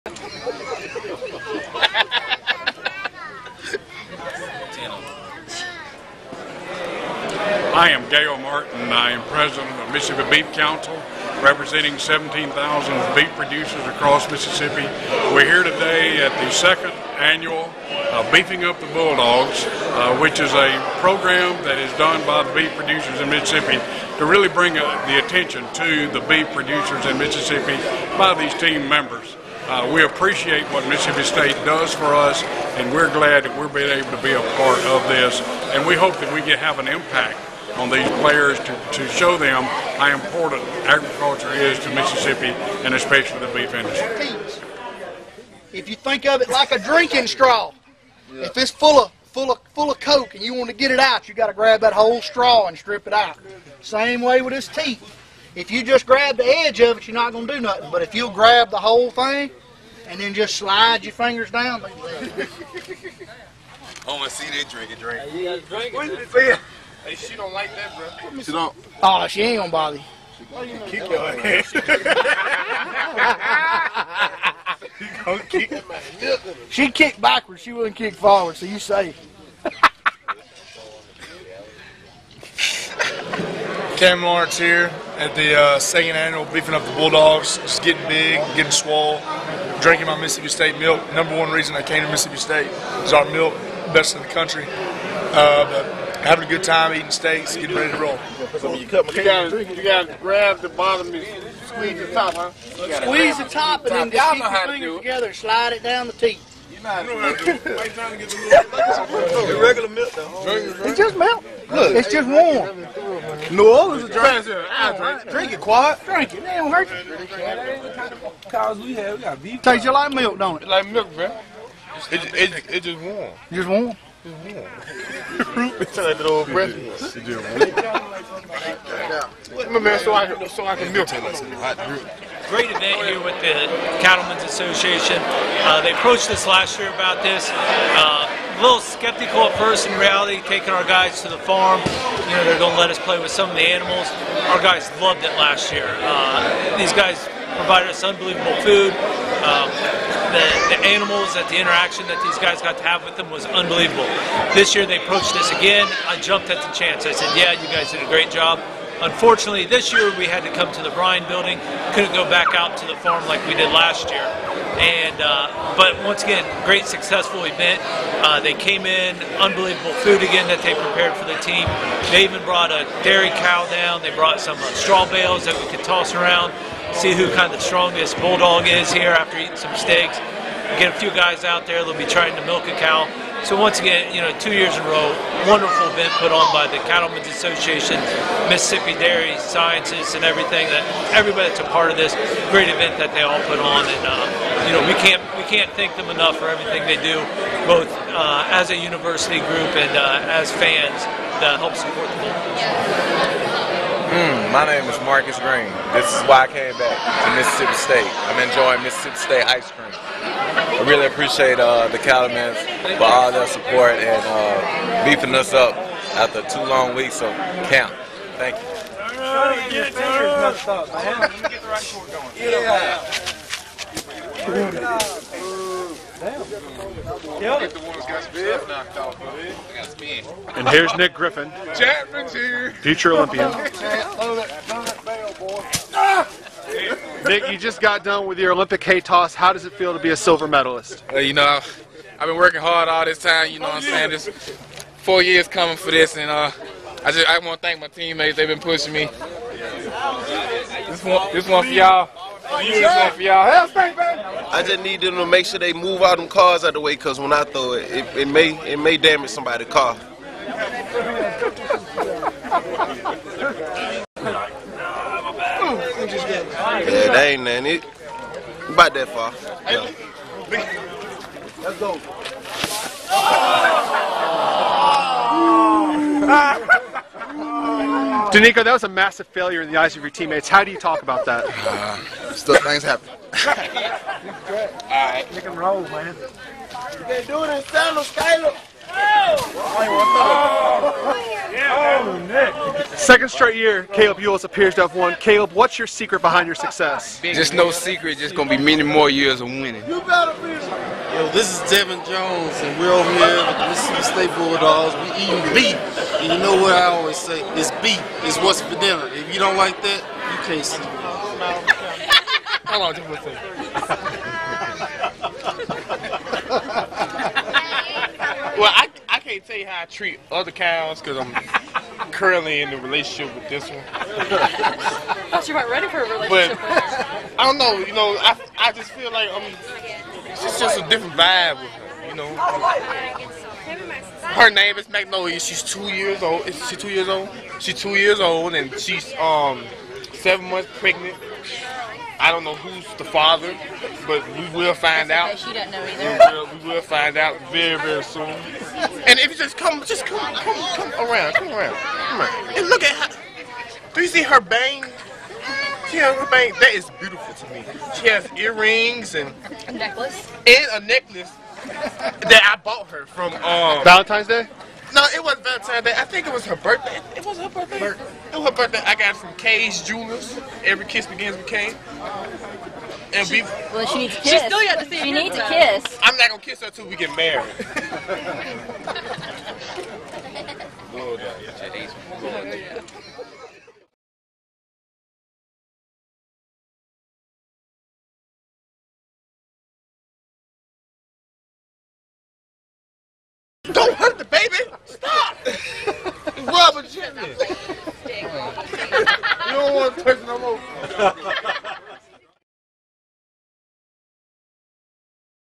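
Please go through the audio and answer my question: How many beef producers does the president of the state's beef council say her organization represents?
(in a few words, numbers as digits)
17,000.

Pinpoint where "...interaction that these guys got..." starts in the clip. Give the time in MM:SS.
02:31.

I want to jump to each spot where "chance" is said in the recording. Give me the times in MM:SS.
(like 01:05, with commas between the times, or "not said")
02:36.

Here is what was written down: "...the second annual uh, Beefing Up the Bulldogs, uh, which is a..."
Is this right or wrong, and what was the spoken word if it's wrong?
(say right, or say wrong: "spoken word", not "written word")
right.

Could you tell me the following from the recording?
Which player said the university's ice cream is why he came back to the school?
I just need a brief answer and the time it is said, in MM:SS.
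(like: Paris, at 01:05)
Marcus Green, at 03:25.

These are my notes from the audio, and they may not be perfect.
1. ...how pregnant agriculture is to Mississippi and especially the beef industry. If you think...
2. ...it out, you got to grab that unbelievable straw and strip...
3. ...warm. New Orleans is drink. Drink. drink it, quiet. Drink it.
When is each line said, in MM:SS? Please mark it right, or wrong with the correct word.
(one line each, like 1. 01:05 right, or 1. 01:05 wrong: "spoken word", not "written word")
1. 00:39 wrong: "important", not "pregnant"
2. 00:50 wrong: "whole", not "unbelievable"
3. 01:52 right.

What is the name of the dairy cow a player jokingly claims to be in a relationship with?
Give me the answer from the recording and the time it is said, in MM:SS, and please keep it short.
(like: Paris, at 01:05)
Magnolia, at 05:34.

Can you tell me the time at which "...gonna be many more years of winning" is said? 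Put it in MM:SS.
04:58.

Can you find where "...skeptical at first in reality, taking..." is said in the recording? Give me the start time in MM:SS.
02:18.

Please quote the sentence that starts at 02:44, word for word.
And uh, but once again, great successful event.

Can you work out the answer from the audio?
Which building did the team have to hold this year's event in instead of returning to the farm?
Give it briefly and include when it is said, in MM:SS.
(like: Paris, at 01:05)
Bryan building, at 02:40.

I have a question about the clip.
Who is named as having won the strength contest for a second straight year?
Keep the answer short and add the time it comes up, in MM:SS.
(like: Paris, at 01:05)
Kaleb Eulls, at 04:53.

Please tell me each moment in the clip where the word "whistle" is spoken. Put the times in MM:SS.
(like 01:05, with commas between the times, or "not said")
not said.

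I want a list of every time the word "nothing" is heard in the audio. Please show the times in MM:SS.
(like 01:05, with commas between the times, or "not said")
00:57, 04:27.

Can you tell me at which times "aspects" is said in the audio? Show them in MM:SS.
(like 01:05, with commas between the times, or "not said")
not said.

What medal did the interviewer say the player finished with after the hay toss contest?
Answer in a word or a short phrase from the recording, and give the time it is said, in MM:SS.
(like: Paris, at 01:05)
Silver, at 04:00.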